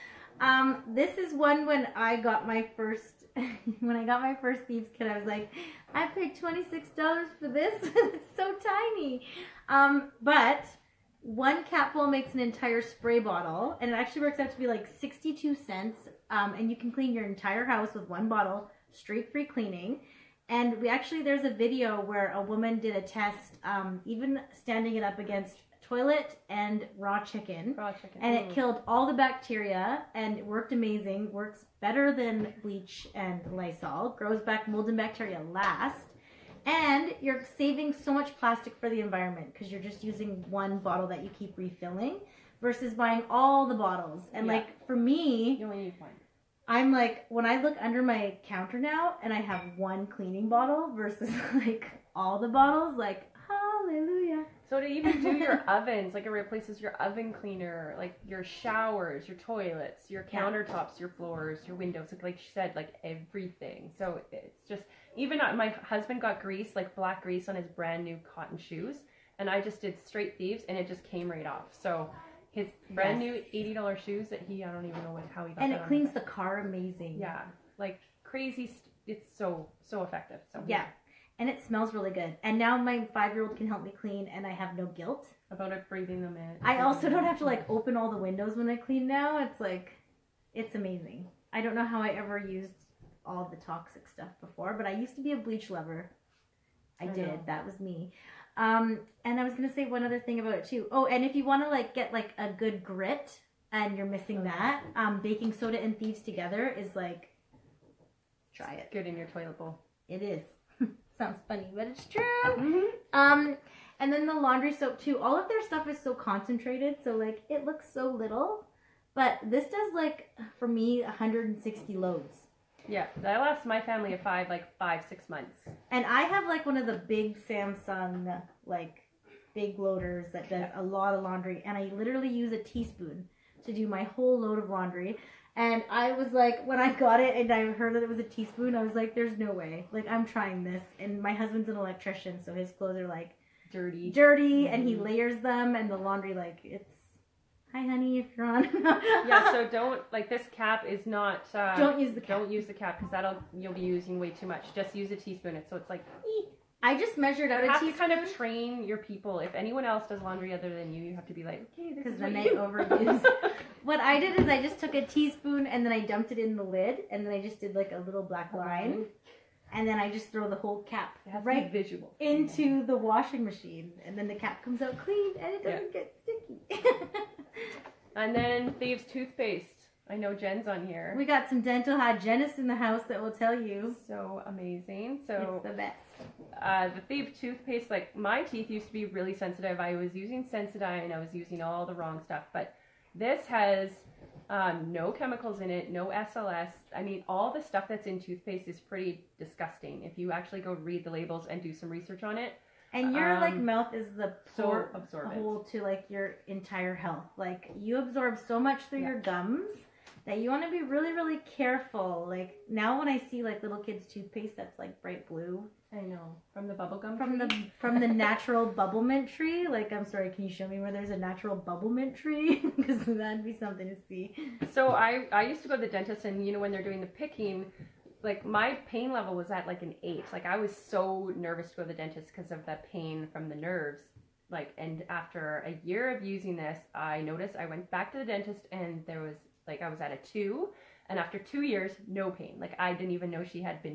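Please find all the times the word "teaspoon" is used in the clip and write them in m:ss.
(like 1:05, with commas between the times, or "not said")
2:12, 2:18, 2:35, 2:45.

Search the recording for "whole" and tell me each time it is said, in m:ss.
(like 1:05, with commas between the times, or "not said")
2:14, 2:50.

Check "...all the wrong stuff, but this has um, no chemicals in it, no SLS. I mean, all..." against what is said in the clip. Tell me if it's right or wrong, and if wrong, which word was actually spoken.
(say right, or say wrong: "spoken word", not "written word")
right.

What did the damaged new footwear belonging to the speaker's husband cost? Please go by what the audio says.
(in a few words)
$80.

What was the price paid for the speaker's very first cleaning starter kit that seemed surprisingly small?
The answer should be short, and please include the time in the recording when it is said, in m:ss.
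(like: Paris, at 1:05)
$26, at 0:06.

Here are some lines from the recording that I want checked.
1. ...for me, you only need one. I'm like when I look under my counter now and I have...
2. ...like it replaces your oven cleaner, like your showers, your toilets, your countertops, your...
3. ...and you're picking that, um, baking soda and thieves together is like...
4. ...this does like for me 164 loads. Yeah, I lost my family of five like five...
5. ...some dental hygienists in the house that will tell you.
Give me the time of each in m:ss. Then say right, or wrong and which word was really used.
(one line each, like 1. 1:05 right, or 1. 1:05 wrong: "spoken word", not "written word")
1. 0:44 right
2. 0:56 right
3. 1:43 wrong: "missing", not "picking"
4. 1:59 wrong: "160", not "164"
5. 3:01 right.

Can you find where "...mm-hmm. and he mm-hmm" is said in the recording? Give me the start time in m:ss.
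2:24.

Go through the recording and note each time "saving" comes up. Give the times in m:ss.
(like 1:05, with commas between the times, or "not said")
0:37.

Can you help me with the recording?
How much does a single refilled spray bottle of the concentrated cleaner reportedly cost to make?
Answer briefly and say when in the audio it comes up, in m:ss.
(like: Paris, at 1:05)
62 cents, at 0:15.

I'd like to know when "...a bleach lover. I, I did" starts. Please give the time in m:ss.
1:35.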